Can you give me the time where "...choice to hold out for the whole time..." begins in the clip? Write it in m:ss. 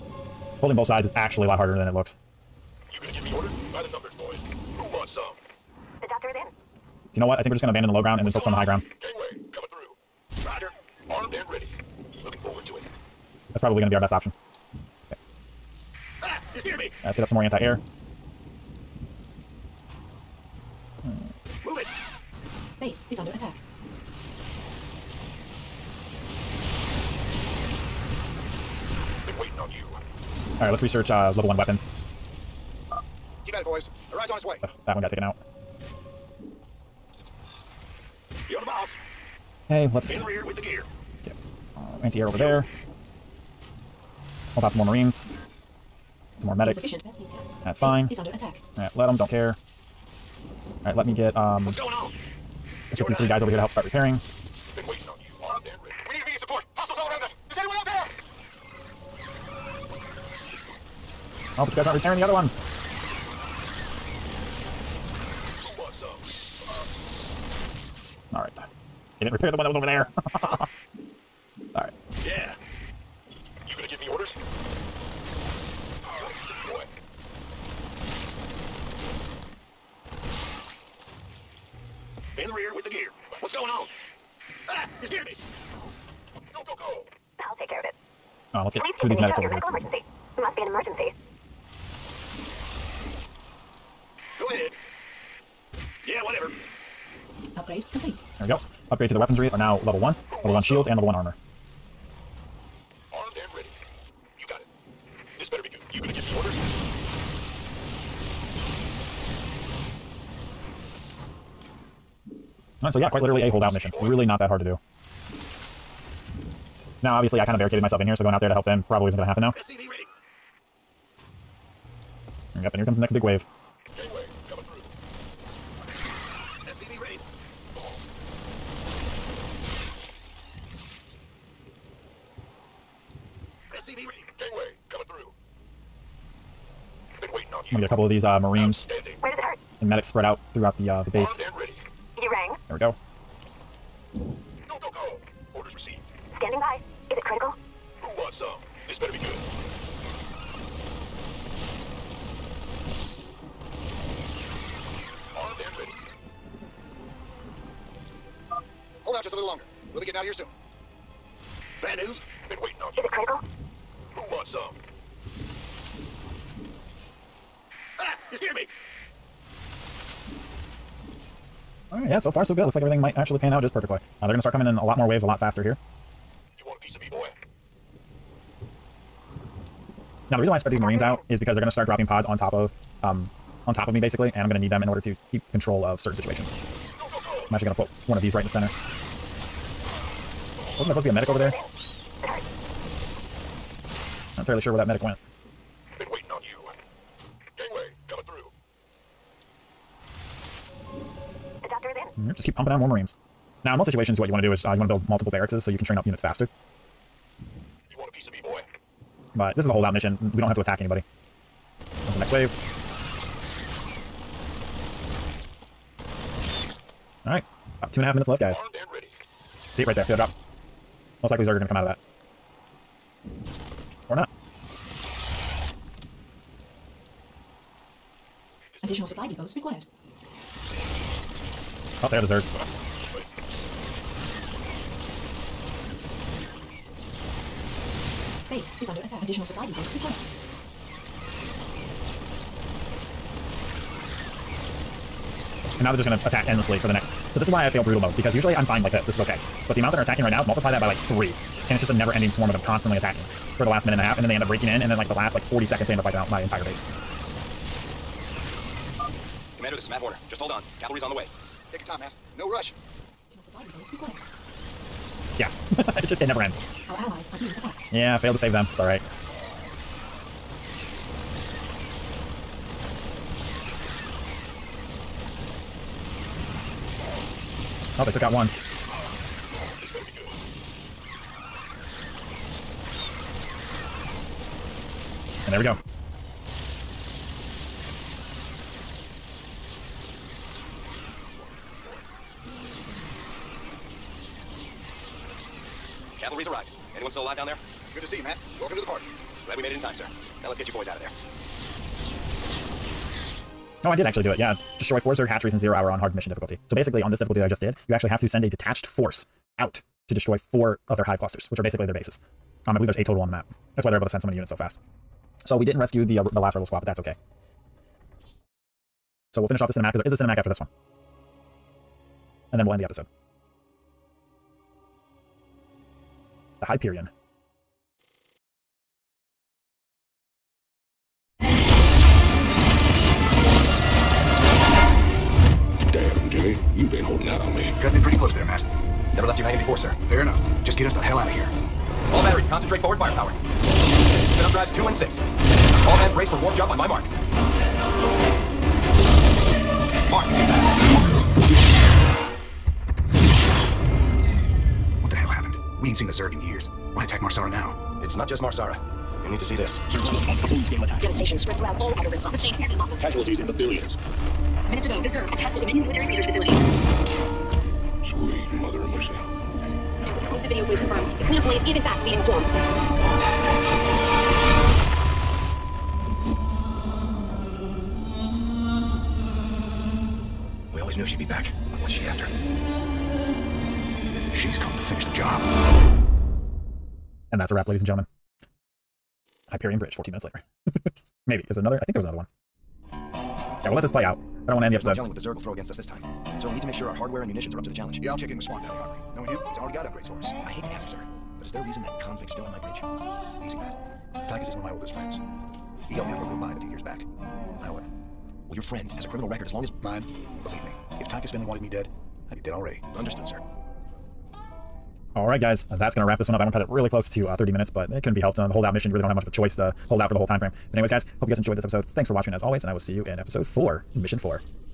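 6:59.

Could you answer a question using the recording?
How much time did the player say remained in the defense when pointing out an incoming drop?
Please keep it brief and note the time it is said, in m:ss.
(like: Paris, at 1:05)
About two and a half minutes, at 3:37.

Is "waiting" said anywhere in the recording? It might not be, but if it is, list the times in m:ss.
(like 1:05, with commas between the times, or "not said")
2:17, 2:42, 3:16.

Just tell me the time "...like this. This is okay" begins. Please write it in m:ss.
4:08.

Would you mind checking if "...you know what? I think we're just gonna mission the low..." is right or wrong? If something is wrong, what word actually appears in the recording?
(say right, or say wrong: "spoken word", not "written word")
wrong: "abandon", not "mission".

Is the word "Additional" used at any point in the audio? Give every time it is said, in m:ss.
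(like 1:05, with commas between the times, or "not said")
3:48, 3:59.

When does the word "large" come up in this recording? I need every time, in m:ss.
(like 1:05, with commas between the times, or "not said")
not said.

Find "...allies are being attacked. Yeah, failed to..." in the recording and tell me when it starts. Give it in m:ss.
4:26.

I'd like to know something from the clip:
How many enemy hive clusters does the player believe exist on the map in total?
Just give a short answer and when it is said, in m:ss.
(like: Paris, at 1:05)
8, at 5:12.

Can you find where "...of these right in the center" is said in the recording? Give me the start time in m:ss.
3:08.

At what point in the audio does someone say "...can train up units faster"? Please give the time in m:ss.
3:25.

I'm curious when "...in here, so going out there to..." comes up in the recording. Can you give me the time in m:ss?
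1:57.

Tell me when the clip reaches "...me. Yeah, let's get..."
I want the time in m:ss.
0:16.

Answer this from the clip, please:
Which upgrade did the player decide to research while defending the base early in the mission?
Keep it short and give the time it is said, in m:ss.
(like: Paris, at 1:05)
Level 1 weapons, at 0:31.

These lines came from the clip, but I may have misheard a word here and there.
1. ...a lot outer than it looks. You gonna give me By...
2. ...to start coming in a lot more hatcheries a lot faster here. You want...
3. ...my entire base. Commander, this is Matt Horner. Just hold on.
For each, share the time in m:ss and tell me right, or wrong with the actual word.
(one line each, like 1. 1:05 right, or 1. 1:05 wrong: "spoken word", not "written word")
1. 0:01 wrong: "harder", not "outer"
2. 2:54 wrong: "waves", not "hatcheries"
3. 4:16 right.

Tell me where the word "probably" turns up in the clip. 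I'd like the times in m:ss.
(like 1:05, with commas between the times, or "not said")
0:13, 1:58.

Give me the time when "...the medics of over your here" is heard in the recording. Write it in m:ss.
1:29.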